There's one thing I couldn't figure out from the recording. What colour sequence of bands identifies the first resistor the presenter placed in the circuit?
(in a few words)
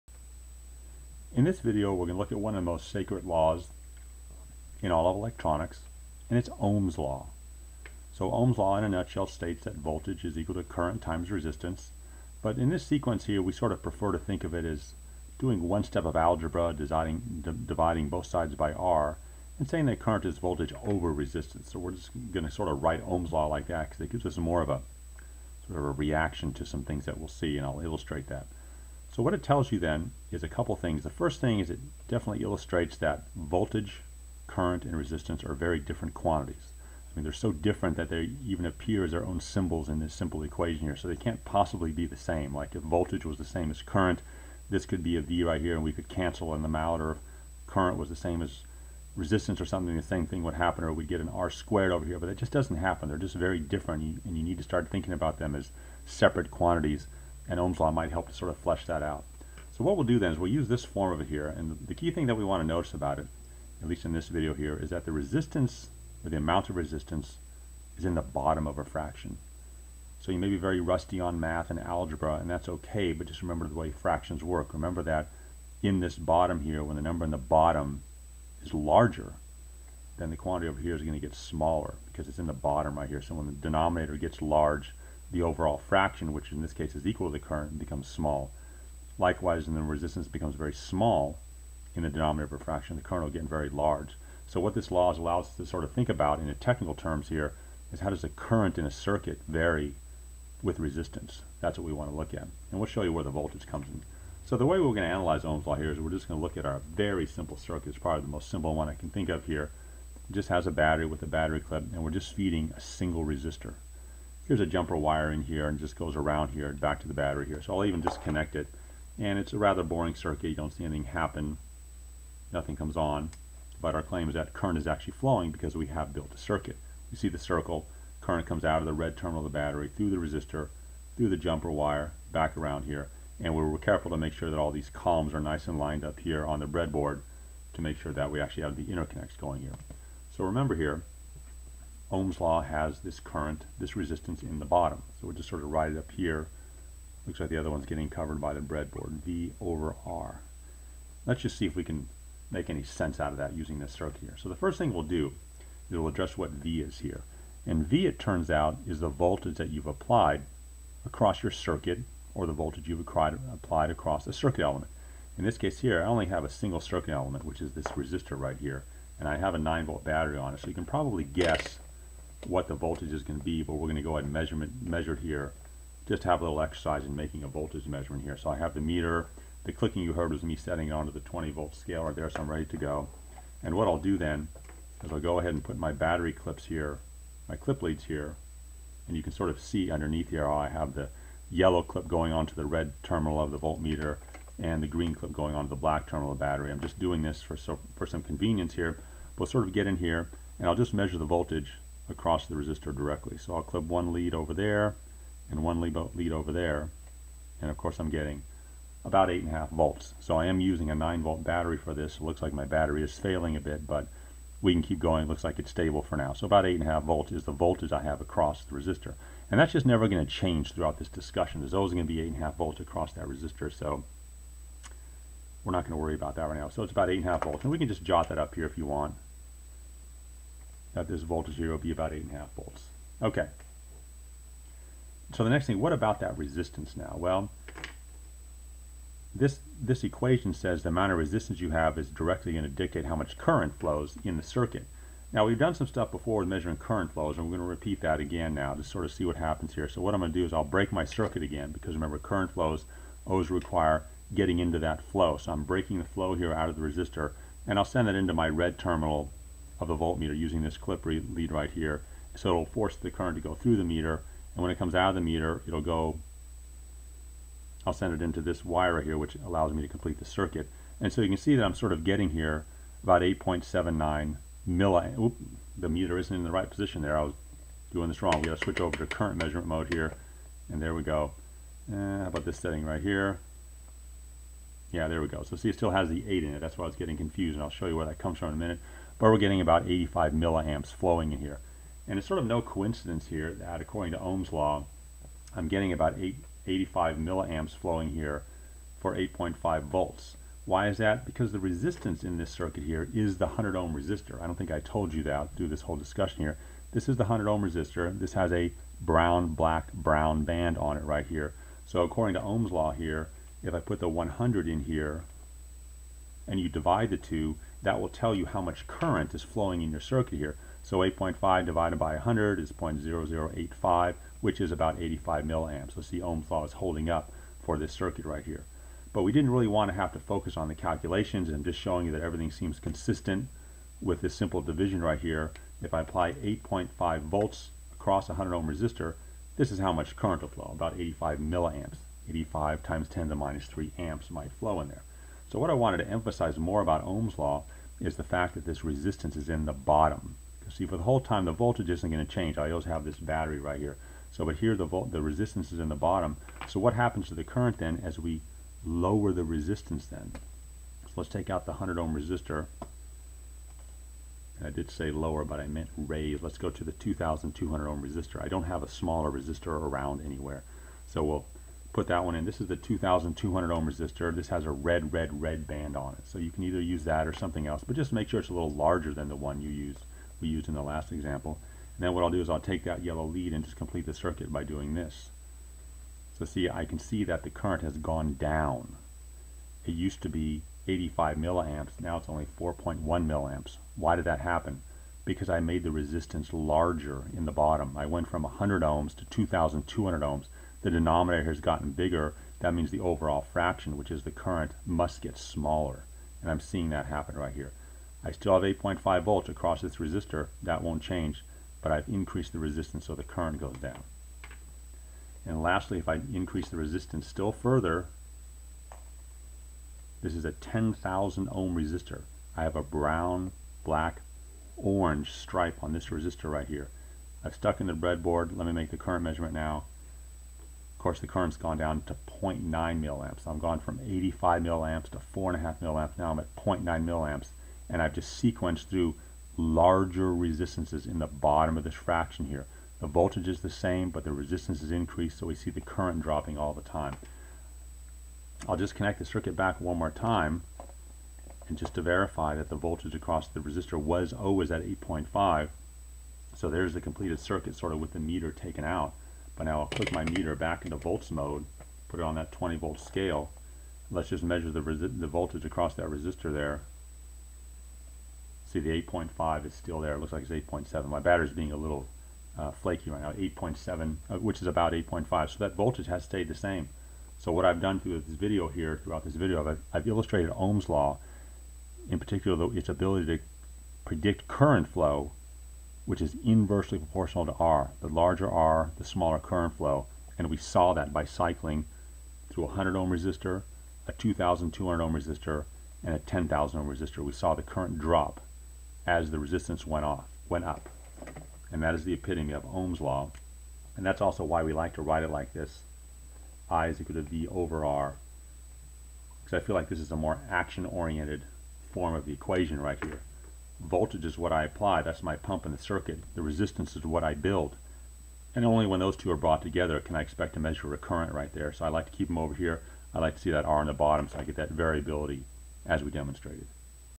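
brown, black, brown.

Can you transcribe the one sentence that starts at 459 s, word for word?
But now I'll click my meter back into volts mode, put it on that 20 volt scale.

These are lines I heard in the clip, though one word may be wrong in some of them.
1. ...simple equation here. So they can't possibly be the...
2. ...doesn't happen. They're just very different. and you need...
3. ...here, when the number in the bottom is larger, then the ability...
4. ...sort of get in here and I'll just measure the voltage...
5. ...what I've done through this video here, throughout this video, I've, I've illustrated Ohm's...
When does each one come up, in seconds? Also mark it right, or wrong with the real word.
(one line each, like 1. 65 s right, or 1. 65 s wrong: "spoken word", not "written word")
1. 40 s right
2. 52 s right
3. 76 s wrong: "quantity", not "ability"
4. 199 s right
5. 477 s right.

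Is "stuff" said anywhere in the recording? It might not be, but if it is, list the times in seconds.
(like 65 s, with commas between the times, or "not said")
245 s.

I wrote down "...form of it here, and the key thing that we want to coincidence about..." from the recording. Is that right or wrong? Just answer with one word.
wrong.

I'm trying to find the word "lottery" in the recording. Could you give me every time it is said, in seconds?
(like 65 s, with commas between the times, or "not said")
not said.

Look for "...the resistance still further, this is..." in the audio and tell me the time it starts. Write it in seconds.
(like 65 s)
416 s.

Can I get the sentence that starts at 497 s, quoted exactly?
We saw the current drop as the resistance went off, went up.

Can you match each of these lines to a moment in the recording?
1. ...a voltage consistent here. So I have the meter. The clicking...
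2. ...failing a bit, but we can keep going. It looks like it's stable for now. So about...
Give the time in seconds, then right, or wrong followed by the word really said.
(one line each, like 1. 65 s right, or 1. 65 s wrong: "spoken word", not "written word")
1. 177 s wrong: "measurement", not "consistent"
2. 213 s right.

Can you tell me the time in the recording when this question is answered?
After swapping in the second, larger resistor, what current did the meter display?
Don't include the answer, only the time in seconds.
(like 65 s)
392 s.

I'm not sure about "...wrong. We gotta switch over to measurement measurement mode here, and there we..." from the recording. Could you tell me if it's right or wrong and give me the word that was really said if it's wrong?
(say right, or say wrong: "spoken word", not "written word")
wrong: "current", not "measurement".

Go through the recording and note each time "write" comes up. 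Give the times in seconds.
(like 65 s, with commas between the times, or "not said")
22 s, 145 s, 505 s.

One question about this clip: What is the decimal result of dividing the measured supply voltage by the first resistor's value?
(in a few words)
0.0085.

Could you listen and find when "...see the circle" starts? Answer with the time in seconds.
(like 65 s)
127 s.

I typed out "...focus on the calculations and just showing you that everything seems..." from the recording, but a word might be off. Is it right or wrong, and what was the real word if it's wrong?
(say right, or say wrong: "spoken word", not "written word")
right.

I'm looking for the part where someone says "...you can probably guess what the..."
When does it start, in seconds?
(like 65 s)
170 s.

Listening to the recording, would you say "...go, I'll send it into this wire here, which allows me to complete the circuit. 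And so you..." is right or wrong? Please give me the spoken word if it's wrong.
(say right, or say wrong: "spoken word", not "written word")
right.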